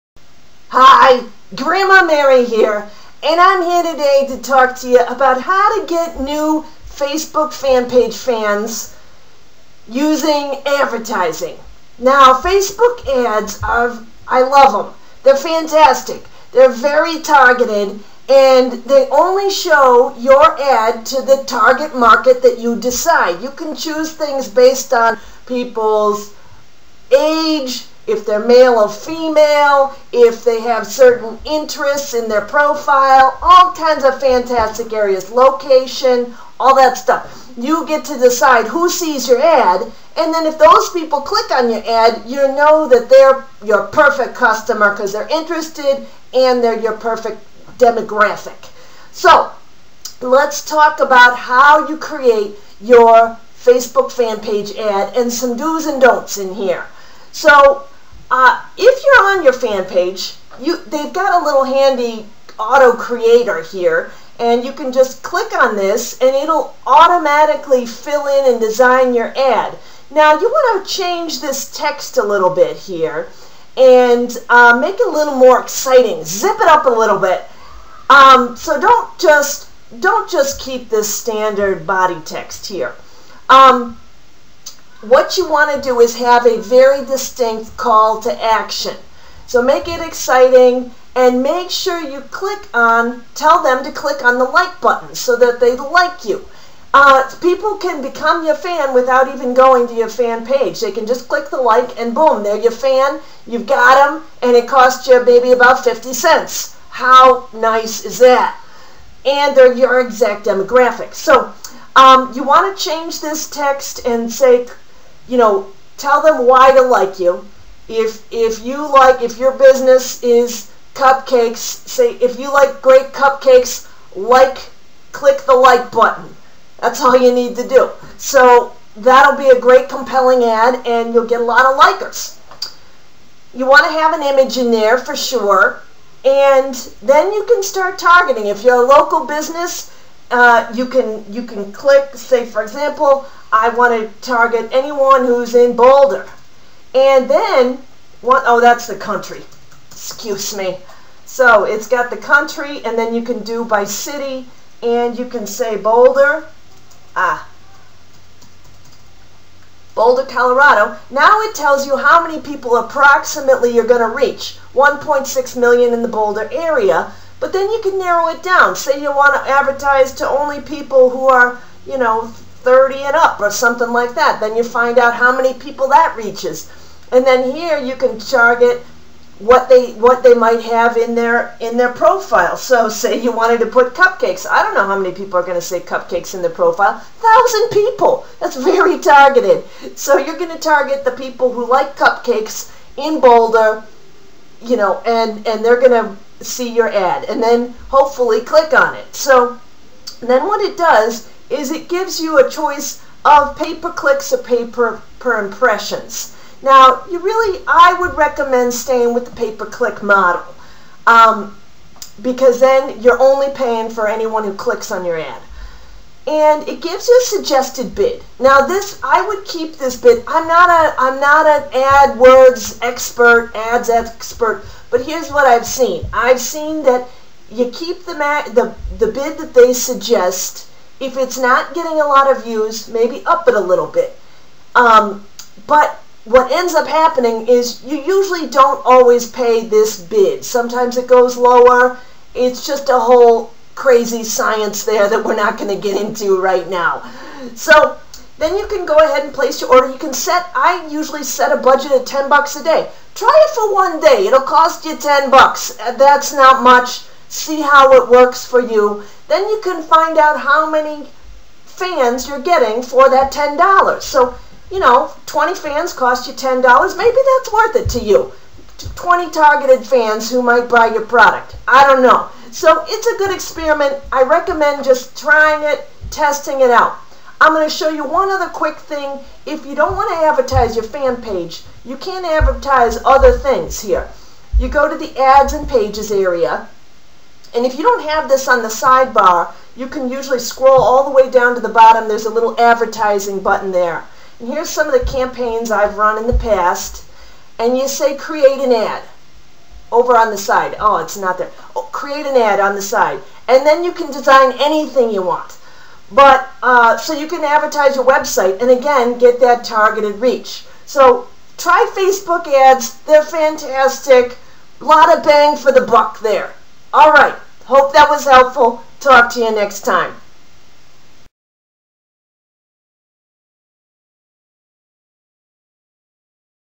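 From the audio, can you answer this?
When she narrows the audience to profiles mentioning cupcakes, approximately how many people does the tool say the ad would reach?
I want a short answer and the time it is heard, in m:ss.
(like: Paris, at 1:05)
1000, at 3:07.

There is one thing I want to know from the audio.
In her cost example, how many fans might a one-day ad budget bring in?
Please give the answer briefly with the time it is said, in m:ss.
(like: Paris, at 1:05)
20, at 4:25.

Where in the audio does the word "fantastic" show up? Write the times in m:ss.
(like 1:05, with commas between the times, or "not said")
0:15, 0:34, 5:13.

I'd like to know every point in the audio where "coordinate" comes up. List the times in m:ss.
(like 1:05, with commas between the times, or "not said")
not said.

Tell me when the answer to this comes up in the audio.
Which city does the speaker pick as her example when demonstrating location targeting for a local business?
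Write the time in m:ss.
2:39.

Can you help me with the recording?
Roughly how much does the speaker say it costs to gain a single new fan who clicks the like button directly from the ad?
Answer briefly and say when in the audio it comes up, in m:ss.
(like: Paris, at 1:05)
50 cents, at 1:45.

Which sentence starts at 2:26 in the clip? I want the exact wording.
And then, oh that's the country, excuse me.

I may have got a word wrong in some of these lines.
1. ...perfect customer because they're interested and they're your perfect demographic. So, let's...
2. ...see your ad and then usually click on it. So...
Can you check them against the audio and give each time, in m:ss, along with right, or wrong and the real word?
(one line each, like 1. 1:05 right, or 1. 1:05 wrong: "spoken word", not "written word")
1. 0:43 right
2. 3:16 wrong: "hopefully", not "usually".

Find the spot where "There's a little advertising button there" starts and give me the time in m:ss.
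4:52.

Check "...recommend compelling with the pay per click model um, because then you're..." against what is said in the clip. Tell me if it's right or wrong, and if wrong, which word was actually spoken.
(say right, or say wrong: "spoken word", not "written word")
wrong: "staying", not "compelling".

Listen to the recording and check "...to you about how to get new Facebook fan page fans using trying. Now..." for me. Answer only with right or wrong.
wrong.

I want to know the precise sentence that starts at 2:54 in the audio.
Then you find out how many people that reaches.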